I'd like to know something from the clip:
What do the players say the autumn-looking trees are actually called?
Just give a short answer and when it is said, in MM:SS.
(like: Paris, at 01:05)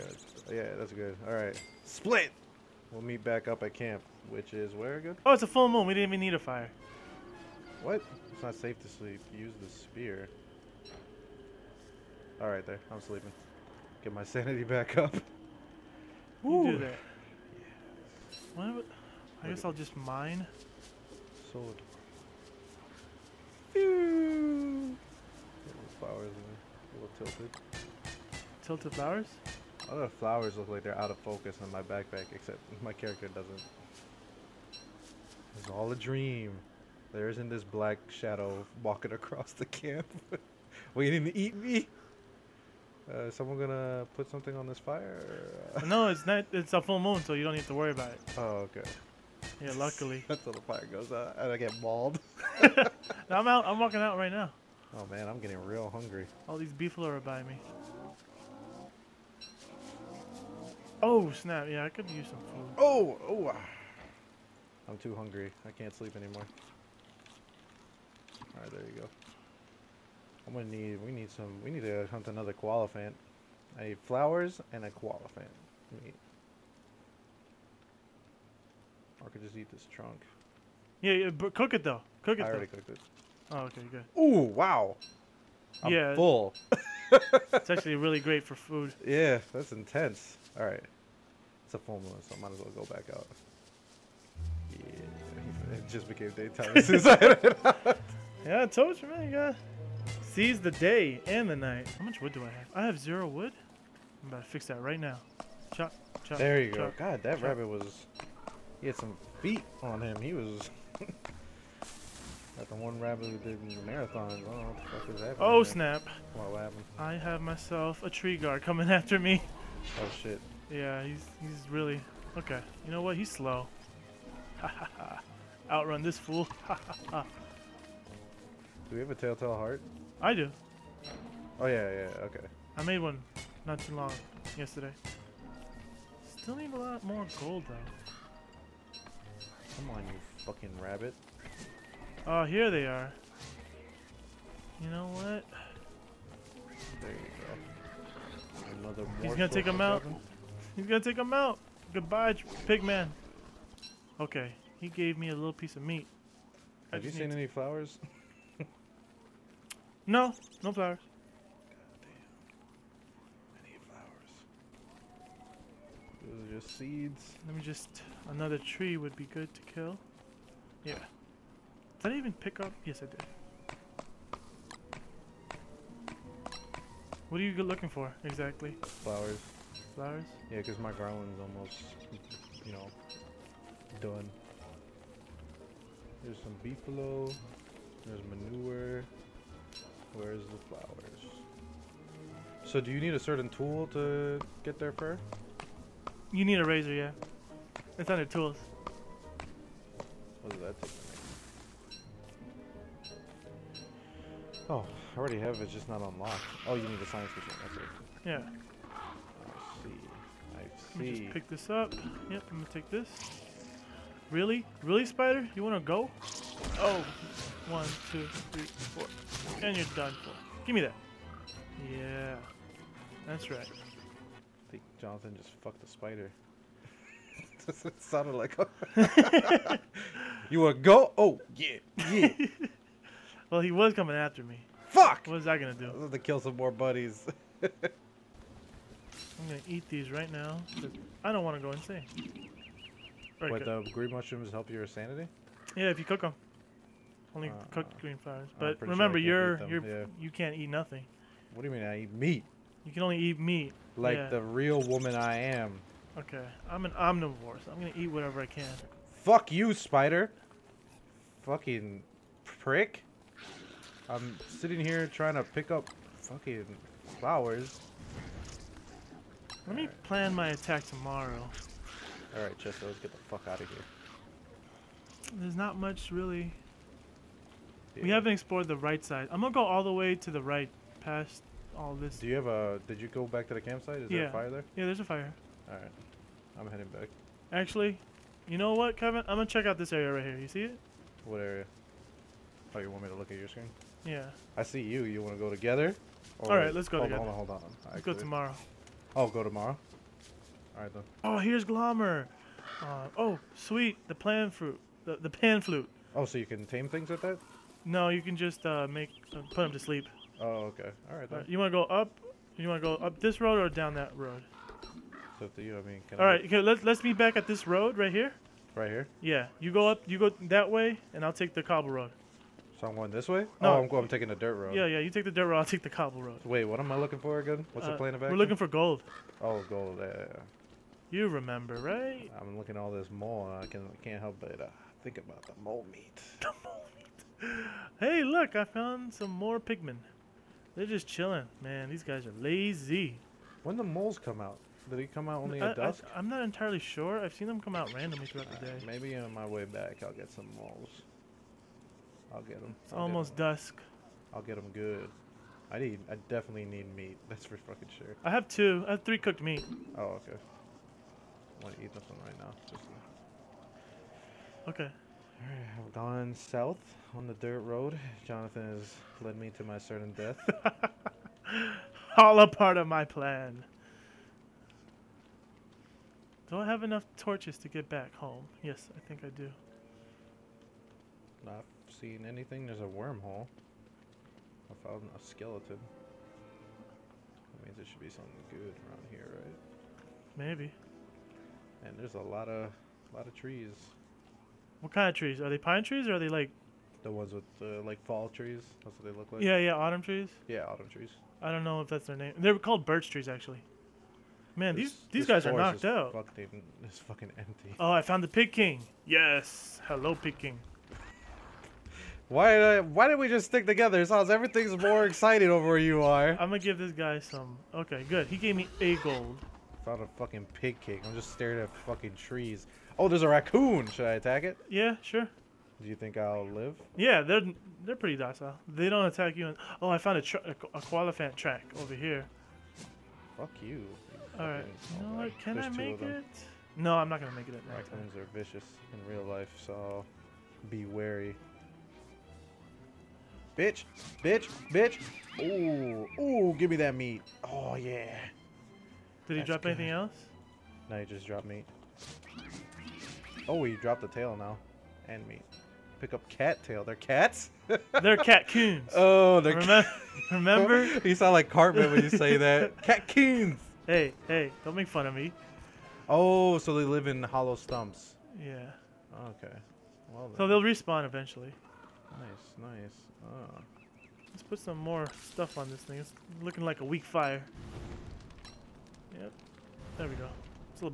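Birch trees, at 06:42.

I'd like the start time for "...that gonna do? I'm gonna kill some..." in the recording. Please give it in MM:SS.
03:55.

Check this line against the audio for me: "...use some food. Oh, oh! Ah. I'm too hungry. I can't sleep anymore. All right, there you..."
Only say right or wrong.
right.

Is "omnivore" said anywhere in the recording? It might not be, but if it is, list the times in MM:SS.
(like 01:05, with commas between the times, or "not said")
04:16.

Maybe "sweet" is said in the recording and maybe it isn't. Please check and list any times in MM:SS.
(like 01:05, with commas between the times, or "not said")
05:03.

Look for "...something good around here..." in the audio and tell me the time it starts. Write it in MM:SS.
06:28.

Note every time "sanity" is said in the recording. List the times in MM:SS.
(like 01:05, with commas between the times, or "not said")
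00:14, 04:04.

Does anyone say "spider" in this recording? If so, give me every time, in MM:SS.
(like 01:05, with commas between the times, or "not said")
03:35, 03:45, 04:19.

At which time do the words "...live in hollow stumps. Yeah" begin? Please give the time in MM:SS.
07:46.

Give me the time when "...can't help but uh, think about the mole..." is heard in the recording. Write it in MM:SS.
05:34.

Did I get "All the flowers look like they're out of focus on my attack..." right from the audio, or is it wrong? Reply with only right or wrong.
wrong.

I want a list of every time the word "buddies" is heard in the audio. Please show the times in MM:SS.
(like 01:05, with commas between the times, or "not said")
03:56.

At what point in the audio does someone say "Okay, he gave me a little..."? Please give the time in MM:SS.
02:34.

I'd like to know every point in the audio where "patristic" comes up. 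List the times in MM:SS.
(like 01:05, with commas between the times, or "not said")
not said.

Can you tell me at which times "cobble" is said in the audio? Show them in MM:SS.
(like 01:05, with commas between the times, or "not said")
05:21, 05:25.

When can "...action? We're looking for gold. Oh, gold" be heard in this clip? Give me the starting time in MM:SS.
05:28.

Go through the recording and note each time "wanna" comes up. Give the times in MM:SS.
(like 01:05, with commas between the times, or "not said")
03:35, 04:01.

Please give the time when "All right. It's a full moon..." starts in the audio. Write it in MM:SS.
01:30.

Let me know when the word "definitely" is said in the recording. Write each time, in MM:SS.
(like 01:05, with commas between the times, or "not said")
05:56.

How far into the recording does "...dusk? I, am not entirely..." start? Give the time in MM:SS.
05:45.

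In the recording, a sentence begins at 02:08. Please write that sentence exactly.
Do we have a telltale heart?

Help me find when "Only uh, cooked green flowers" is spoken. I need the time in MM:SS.
04:07.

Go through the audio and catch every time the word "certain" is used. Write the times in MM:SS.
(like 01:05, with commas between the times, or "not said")
03:13, 06:09.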